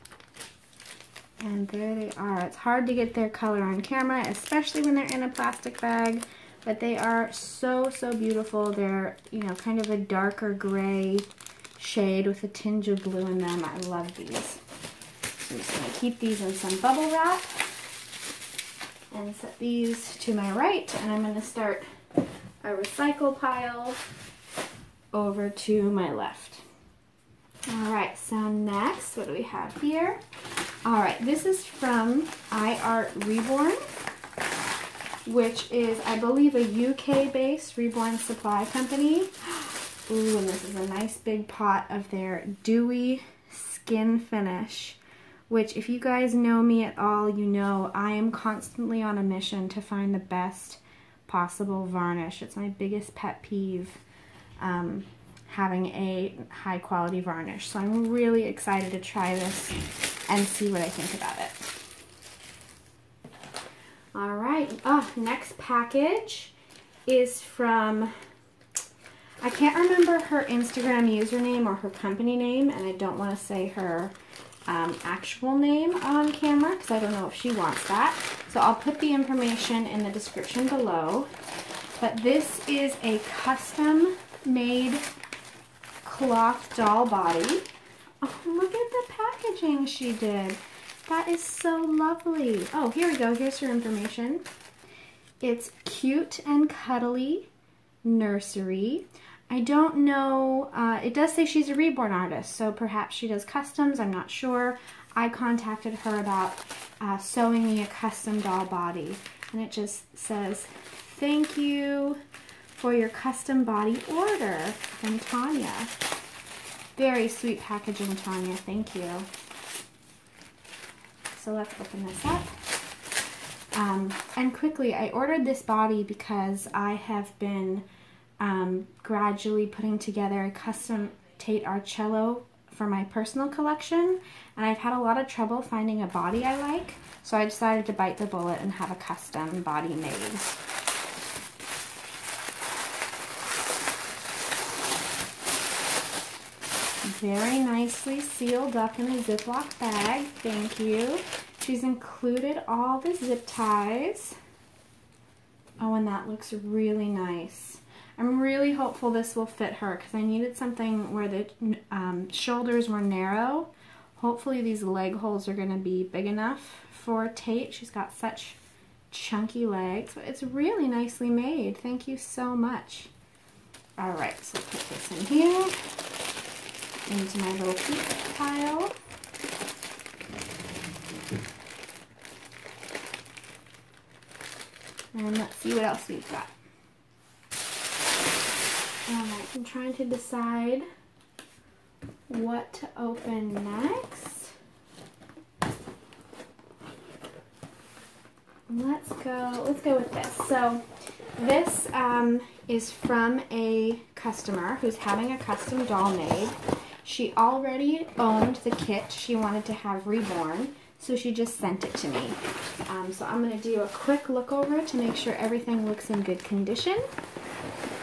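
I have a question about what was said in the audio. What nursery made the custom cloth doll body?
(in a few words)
Cute and Cuddly Nursery.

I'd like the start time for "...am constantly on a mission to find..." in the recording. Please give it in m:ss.
0:48.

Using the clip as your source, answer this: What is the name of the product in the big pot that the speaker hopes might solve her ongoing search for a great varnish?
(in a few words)
dewy skin finish.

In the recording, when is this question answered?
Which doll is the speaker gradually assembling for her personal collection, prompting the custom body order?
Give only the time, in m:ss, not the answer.
2:11.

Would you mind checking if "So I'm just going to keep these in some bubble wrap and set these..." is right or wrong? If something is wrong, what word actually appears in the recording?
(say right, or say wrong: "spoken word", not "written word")
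right.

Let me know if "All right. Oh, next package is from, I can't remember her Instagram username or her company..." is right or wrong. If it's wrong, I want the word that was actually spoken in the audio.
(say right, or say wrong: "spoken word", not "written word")
right.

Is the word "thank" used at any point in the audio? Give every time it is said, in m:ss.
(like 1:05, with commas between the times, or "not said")
1:51, 1:58, 2:30, 2:51.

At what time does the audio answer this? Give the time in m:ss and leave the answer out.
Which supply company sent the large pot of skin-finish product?
0:32.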